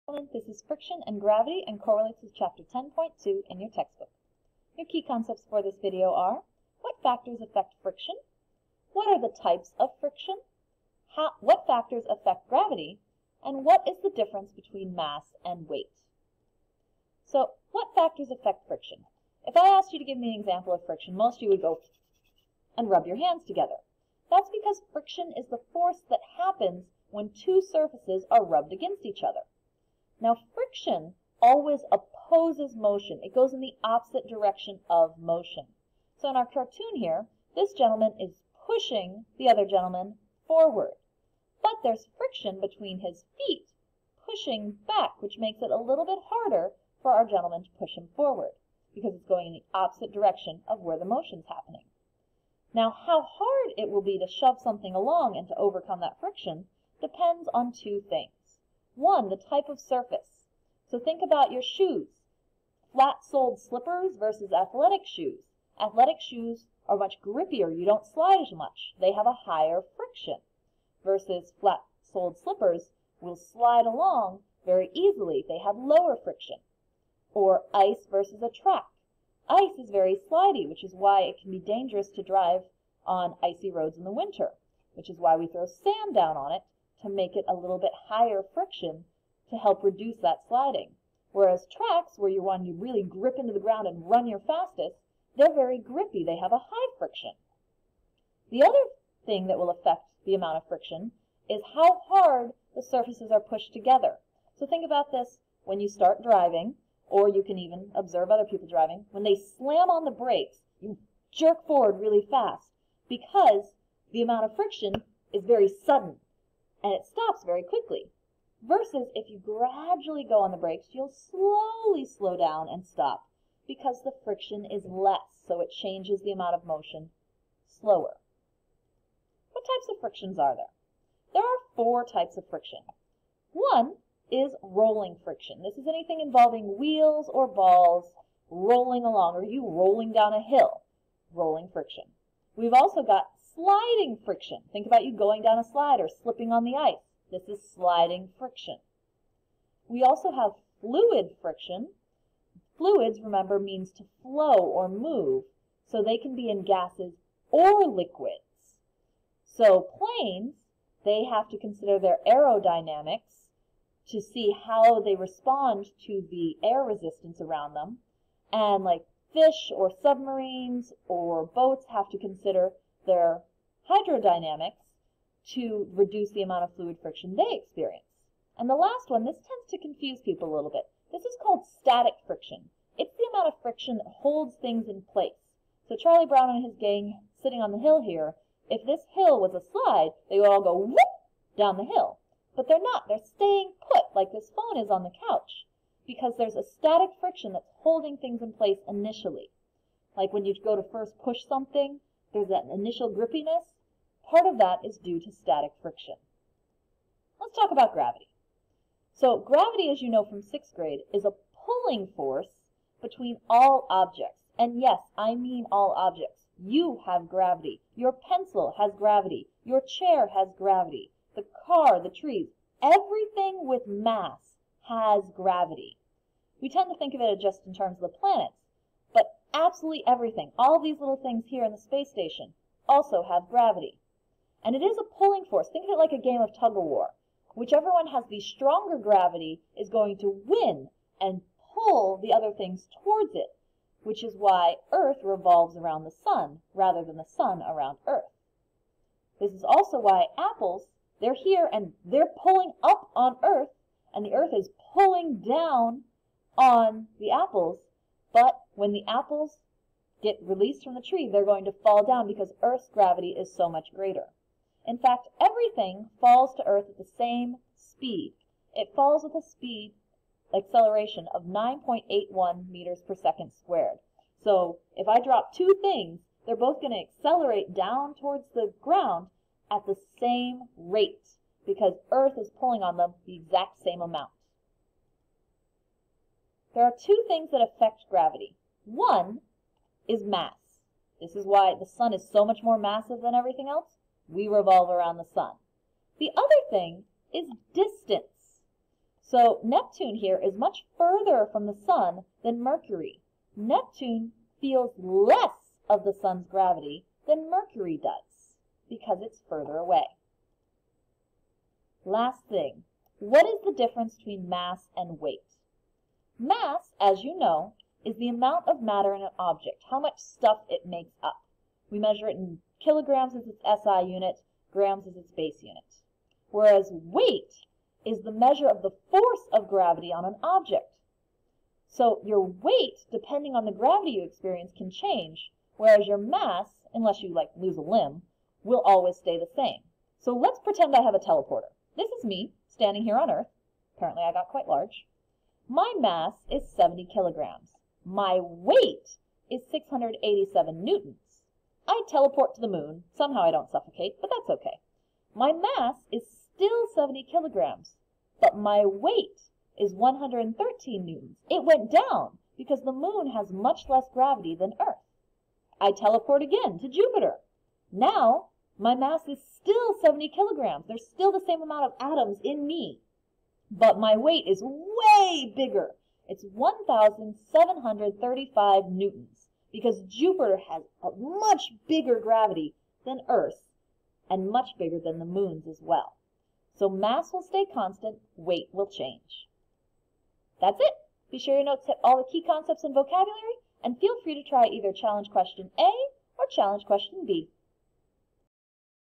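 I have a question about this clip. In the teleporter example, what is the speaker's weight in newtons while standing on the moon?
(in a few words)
113 newtons.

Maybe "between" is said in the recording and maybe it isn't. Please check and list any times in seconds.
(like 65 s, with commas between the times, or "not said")
14 s, 42 s, 213 s, 314 s.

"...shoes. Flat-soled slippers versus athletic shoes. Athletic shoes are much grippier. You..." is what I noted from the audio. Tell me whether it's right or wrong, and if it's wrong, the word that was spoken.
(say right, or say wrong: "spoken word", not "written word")
right.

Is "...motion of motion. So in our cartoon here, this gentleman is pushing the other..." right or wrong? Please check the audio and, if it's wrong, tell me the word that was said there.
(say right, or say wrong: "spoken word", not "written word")
wrong: "direction", not "motion".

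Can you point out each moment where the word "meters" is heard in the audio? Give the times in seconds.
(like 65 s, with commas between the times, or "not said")
272 s.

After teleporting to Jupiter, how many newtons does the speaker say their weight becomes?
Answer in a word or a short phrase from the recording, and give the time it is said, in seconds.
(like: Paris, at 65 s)
1,735 newtons, at 376 s.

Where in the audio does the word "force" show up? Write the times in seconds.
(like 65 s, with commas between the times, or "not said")
25 s, 212 s, 235 s, 328 s.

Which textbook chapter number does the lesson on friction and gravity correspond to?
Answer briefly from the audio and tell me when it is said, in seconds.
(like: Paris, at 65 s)
10.2, at 2 s.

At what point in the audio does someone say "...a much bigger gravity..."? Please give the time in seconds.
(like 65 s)
381 s.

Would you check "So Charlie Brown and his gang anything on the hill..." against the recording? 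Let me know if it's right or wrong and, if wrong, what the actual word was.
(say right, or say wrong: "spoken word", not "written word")
wrong: "sitting", not "anything".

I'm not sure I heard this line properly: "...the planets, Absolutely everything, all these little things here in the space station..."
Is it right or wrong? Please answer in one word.
right.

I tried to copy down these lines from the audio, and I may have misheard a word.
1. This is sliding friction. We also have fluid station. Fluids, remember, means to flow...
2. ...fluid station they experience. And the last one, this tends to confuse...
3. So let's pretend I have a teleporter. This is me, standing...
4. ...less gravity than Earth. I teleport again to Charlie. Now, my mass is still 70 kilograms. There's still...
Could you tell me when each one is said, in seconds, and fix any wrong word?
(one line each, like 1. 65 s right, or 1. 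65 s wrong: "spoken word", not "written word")
1. 147 s wrong: "friction", not "station"
2. 176 s wrong: "friction", not "station"
3. 340 s right
4. 363 s wrong: "Jupiter", not "Charlie".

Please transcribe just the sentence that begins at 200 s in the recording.
Like when you go to first push something, there's that initial grippiness.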